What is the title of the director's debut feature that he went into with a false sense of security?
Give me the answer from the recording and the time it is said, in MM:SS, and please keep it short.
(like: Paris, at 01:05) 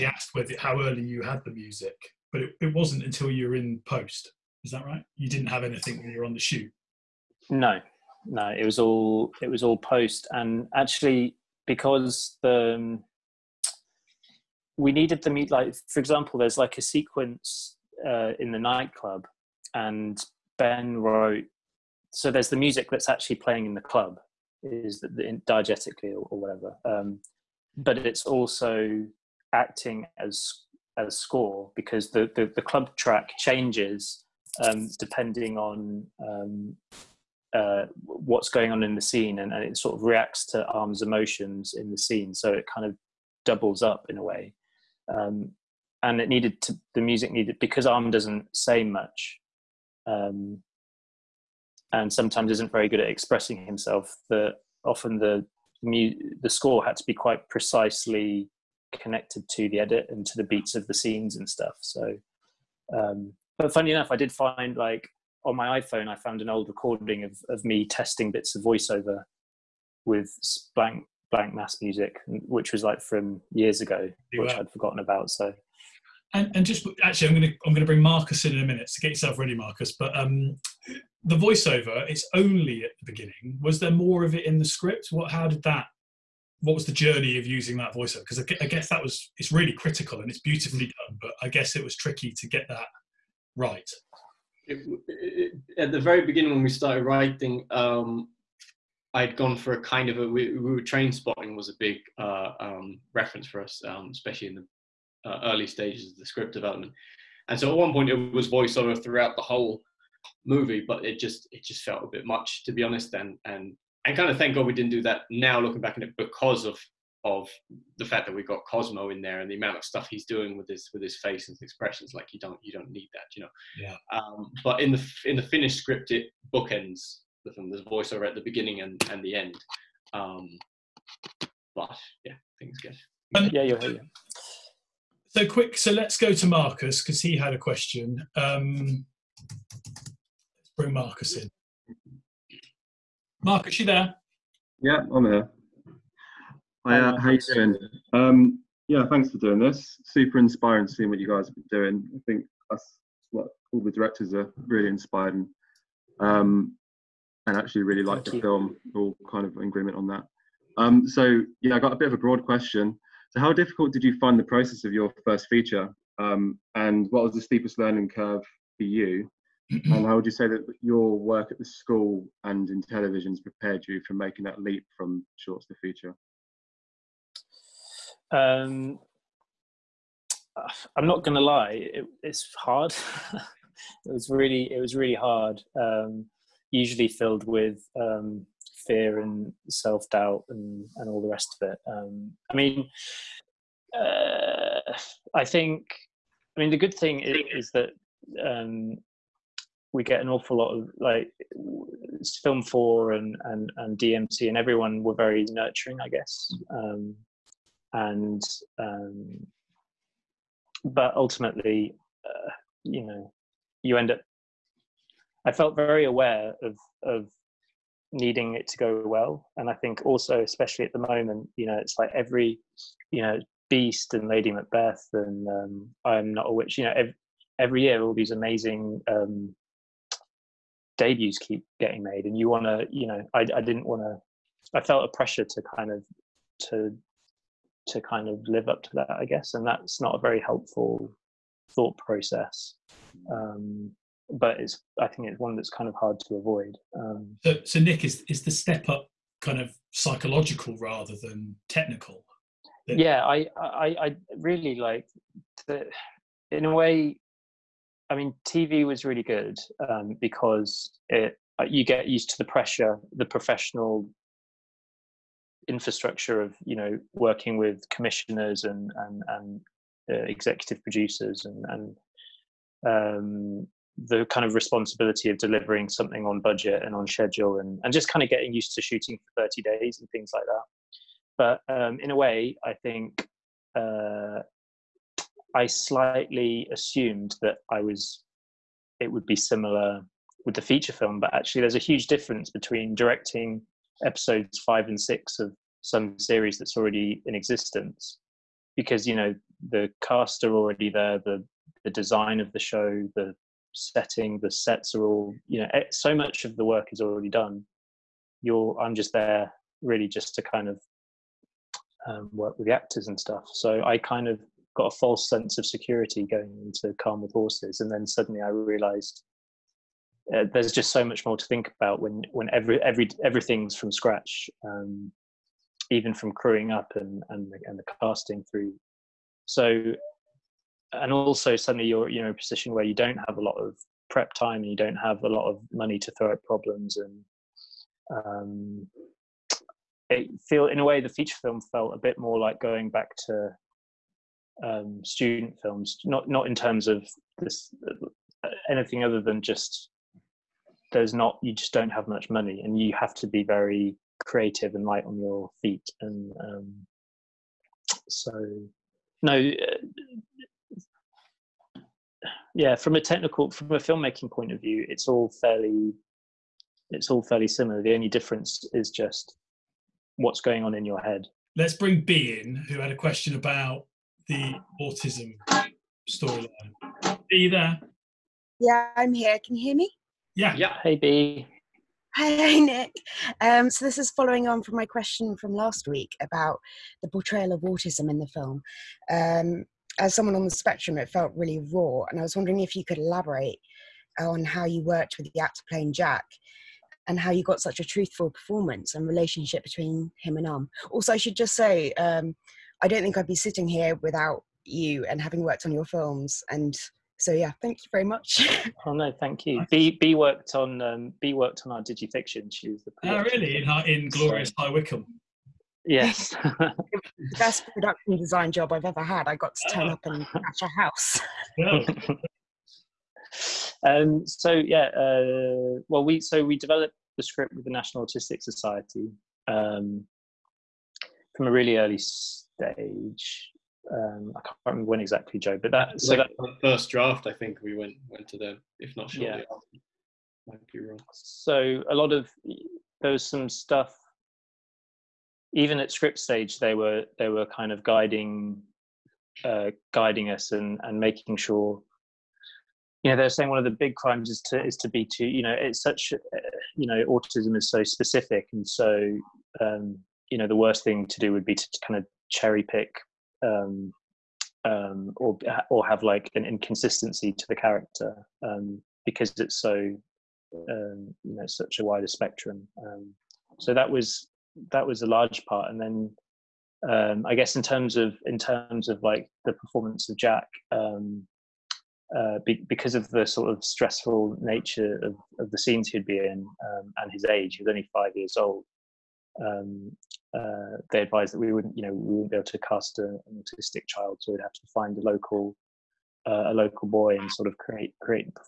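Calm with Horses, at 05:16.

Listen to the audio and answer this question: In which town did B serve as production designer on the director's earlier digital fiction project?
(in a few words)
High Wycombe.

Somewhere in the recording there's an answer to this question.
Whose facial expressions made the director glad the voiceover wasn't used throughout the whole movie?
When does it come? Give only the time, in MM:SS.
01:58.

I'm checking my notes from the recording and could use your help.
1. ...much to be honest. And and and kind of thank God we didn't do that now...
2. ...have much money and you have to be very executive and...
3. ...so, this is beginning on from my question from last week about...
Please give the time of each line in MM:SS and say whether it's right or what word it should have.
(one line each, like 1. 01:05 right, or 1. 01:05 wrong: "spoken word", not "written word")
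1. 01:52 right
2. 05:51 wrong: "creative", not "executive"
3. 06:23 wrong: "following", not "beginning".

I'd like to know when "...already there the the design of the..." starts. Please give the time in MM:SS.
05:00.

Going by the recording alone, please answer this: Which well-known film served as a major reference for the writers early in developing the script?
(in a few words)
Trainspotting.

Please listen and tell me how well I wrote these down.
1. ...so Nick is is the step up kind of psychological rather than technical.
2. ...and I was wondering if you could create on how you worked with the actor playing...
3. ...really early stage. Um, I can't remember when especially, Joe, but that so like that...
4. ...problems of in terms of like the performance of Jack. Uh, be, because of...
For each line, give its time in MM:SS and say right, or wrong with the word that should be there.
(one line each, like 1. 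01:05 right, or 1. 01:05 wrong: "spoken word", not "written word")
1. 04:07 right
2. 06:32 wrong: "elaborate", not "create"
3. 07:11 wrong: "exactly", not "especially"
4. 07:57 wrong: "terms", not "problems".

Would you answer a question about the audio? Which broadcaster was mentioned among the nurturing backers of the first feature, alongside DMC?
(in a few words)
Film Four.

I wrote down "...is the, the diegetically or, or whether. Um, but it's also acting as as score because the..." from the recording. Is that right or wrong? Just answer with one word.
wrong.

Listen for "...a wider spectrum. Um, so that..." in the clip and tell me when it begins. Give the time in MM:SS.
07:51.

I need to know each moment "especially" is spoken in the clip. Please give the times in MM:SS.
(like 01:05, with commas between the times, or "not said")
01:44, 03:40.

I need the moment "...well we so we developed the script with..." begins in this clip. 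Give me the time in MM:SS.
07:05.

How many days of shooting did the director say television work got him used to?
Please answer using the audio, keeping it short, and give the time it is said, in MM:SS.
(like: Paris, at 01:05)
30, at 04:39.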